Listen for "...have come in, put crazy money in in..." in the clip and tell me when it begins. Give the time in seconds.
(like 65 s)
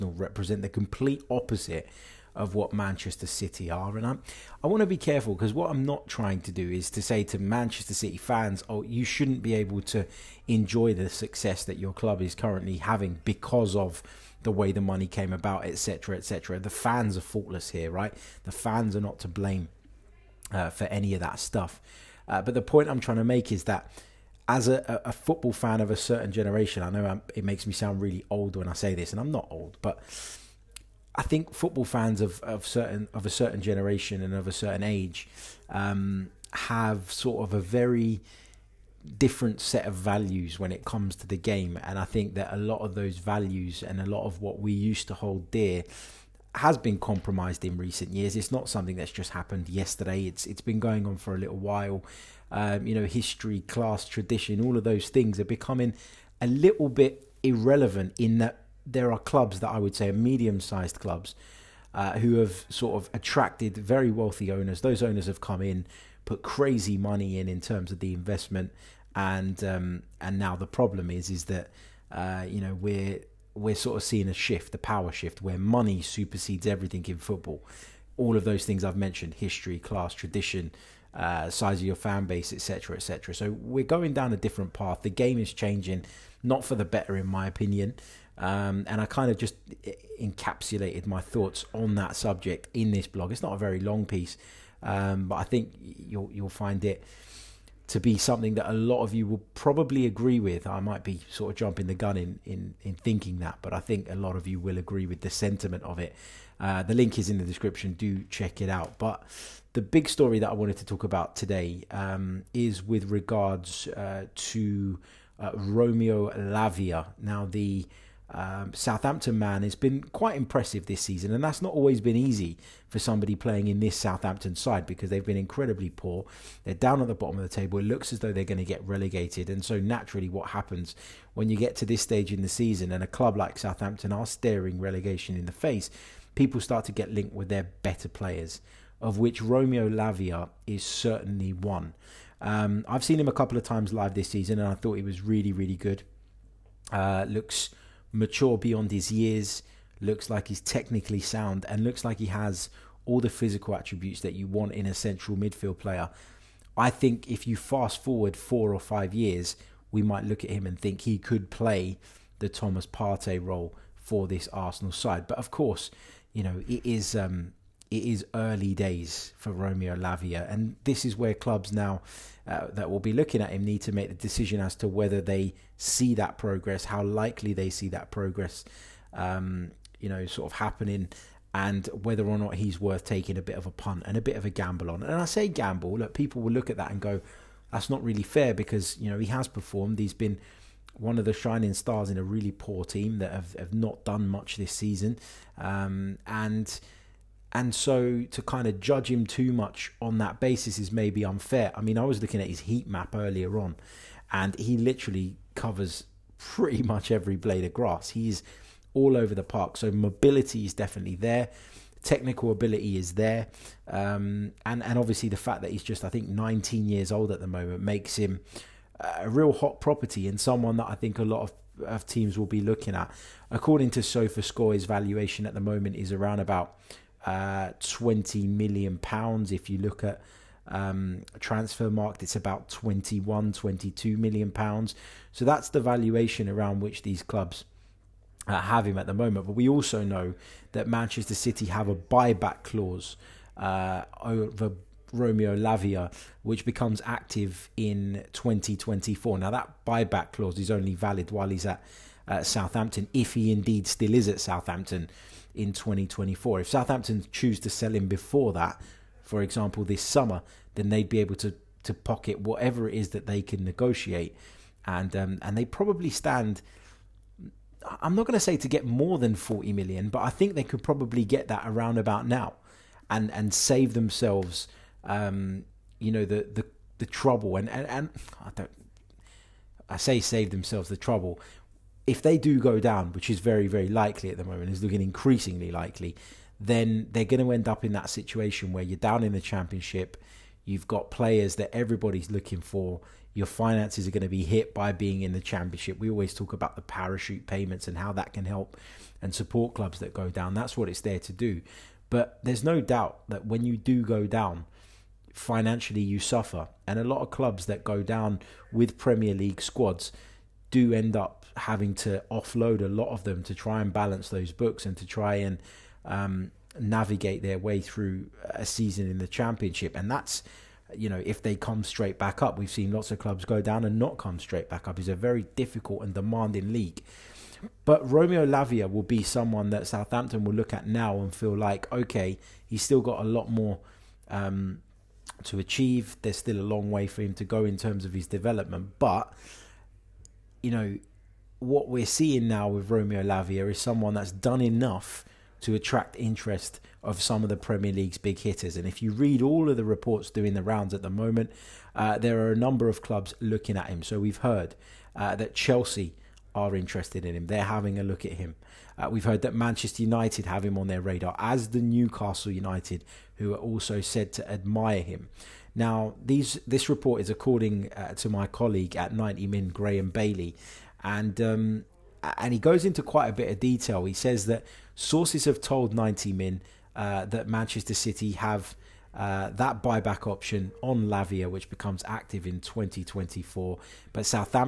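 65 s.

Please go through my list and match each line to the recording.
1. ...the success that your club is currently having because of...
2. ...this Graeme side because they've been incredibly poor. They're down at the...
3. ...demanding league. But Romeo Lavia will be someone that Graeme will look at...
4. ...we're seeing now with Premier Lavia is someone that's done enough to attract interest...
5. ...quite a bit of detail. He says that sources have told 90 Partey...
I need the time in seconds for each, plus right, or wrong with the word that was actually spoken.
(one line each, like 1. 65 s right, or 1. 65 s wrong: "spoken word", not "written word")
1. 10 s right
2. 123 s wrong: "Southampton", not "Graeme"
3. 326 s wrong: "Southampton", not "Graeme"
4. 341 s wrong: "Romeo", not "Premier"
5. 373 s wrong: "Min", not "Partey".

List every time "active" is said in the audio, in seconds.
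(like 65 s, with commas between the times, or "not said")
247 s, 382 s.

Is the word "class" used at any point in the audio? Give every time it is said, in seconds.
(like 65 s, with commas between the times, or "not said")
53 s, 79 s.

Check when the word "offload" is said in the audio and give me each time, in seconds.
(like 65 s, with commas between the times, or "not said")
312 s.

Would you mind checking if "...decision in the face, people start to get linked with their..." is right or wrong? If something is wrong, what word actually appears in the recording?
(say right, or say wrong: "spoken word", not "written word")
wrong: "relegation", not "decision".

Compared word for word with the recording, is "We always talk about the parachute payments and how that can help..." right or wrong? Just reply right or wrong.
right.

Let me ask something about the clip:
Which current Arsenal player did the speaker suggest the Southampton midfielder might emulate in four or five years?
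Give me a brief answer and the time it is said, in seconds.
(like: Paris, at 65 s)
Thomas Partey, at 162 s.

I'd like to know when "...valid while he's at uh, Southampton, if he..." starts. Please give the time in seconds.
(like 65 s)
250 s.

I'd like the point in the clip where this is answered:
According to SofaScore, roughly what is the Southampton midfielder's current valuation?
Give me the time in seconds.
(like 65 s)
227 s.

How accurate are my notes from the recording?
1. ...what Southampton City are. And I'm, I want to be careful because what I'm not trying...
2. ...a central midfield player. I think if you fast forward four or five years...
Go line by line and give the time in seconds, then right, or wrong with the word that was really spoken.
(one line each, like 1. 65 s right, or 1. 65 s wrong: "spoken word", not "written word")
1. 2 s wrong: "Manchester", not "Southampton"
2. 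154 s right.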